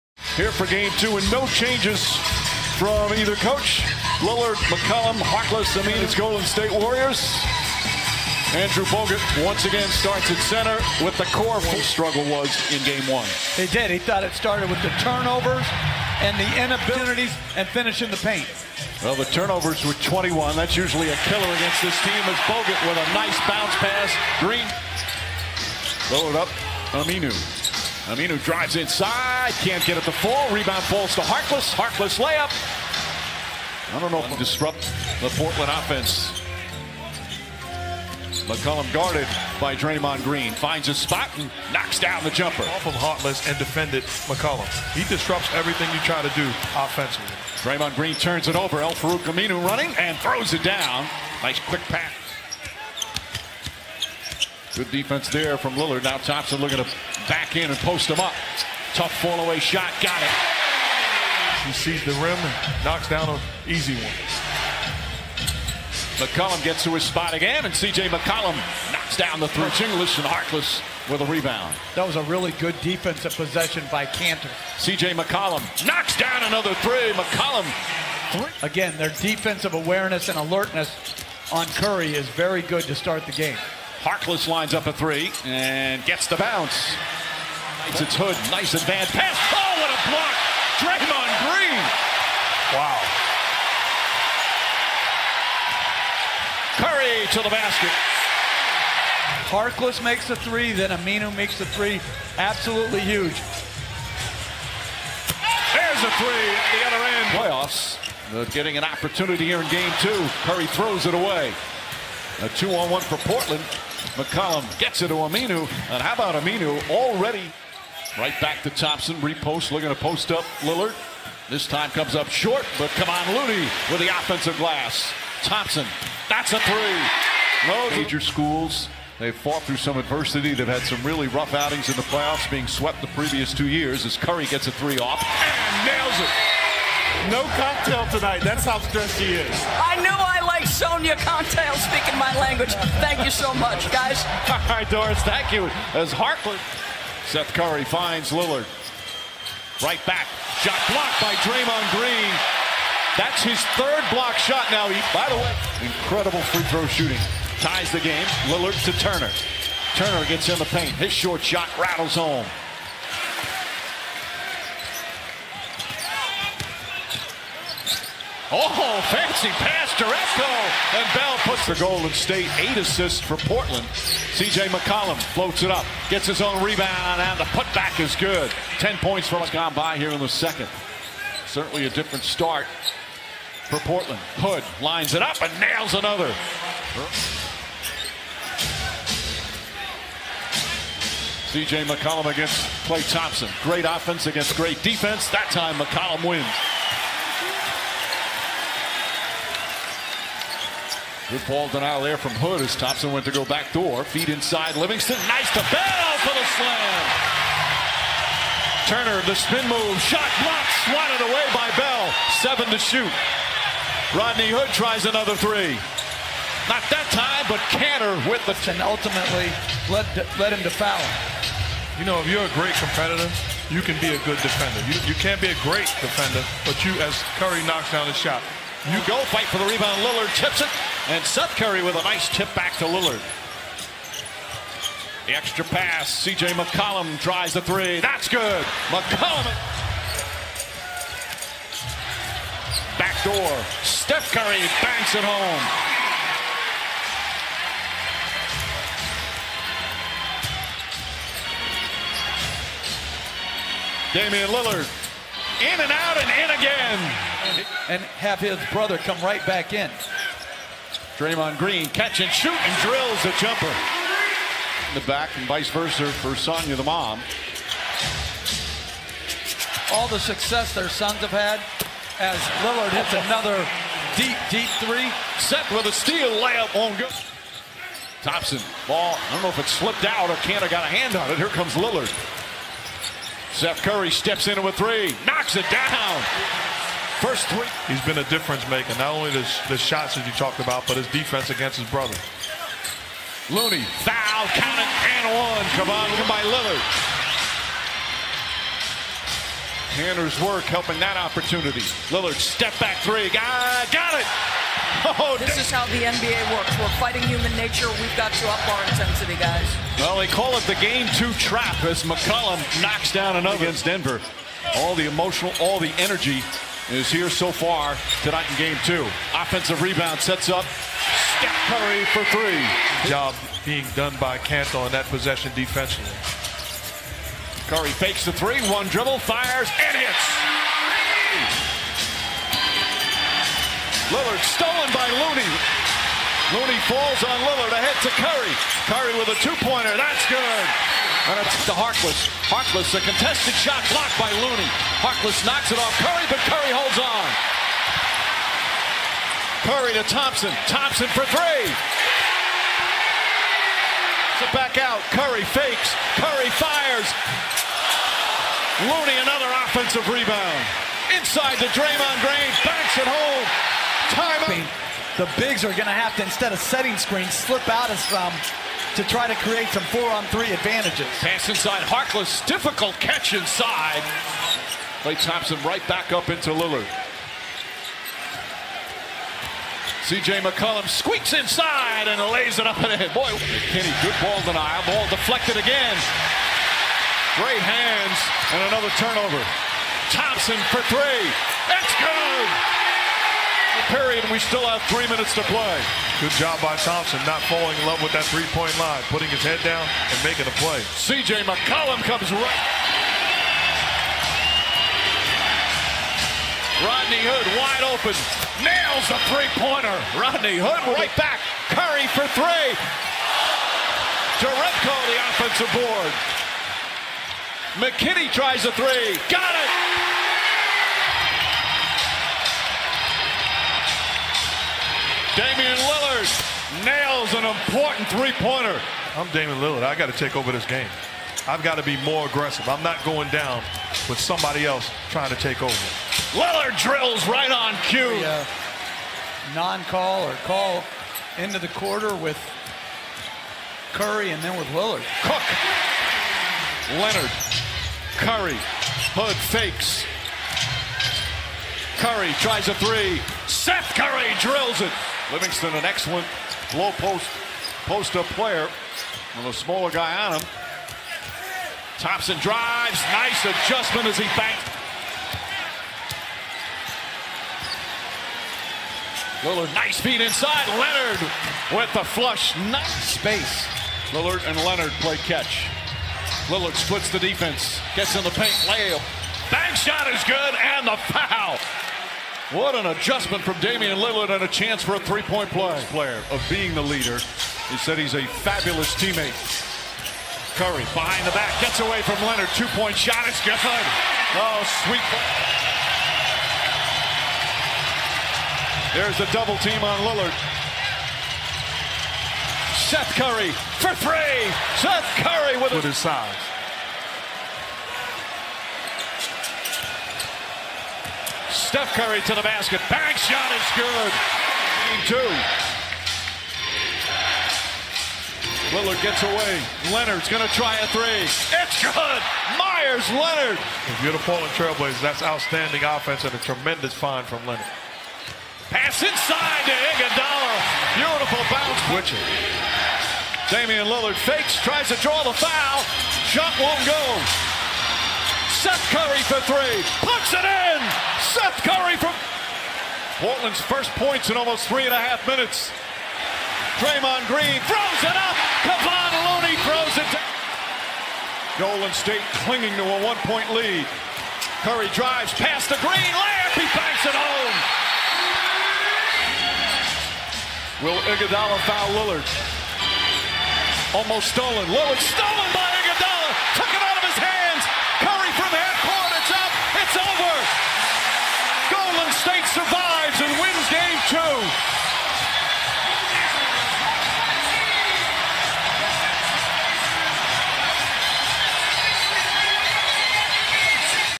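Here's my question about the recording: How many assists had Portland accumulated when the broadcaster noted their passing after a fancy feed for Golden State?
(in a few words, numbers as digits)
8.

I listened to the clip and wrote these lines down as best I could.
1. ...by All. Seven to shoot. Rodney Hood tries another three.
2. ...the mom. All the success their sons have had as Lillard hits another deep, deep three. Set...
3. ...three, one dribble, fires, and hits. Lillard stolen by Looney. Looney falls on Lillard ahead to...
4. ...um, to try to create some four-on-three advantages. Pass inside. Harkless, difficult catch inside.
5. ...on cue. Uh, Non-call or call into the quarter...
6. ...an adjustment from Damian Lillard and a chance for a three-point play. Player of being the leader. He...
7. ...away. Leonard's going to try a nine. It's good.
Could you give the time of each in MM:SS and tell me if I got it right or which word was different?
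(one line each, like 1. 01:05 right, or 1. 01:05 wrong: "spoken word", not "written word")
1. 03:31 wrong: "Bell", not "All"
2. 04:26 right
3. 05:28 right
4. 06:08 right
5. 07:17 right
6. 08:02 right
7. 08:39 wrong: "three", not "nine".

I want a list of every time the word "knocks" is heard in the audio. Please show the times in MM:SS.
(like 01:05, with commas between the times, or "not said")
00:41, 01:02, 01:08, 01:15, 03:47, 04:45, 05:12, 05:45.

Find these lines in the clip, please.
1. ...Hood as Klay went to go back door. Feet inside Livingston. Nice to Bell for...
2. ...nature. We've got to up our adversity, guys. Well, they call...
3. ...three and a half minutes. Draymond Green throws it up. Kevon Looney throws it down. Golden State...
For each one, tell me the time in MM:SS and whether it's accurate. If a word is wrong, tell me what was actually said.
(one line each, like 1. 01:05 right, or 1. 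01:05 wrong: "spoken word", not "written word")
1. 03:22 wrong: "Thompson", not "Klay"
2. 05:07 wrong: "intensity", not "adversity"
3. 09:04 right.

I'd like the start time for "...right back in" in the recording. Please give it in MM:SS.
04:19.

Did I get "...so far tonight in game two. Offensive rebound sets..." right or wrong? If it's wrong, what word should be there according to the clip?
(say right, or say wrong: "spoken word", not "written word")
right.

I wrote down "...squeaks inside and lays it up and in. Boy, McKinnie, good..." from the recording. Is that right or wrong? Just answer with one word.
right.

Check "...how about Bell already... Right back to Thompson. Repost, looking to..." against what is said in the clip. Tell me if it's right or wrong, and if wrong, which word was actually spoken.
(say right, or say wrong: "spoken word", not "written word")
wrong: "Aminu", not "Bell".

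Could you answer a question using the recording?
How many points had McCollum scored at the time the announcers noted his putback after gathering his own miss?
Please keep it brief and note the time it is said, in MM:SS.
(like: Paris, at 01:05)
10, at 02:58.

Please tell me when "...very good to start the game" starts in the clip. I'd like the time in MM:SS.
01:22.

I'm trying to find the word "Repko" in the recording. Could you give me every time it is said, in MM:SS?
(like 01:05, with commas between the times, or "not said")
02:50.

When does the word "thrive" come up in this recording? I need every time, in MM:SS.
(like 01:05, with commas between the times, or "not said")
not said.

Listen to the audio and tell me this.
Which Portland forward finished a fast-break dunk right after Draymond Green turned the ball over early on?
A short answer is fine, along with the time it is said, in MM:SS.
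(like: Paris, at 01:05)
Al-Farouq Aminu, at 00:48.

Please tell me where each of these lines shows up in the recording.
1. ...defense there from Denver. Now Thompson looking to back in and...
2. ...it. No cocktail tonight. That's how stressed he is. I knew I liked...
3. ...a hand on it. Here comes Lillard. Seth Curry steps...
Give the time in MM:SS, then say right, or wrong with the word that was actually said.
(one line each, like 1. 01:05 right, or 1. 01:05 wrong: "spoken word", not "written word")
1. 00:54 wrong: "Lillard", not "Denver"
2. 02:16 right
3. 04:40 right.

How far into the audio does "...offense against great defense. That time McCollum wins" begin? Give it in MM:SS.
03:13.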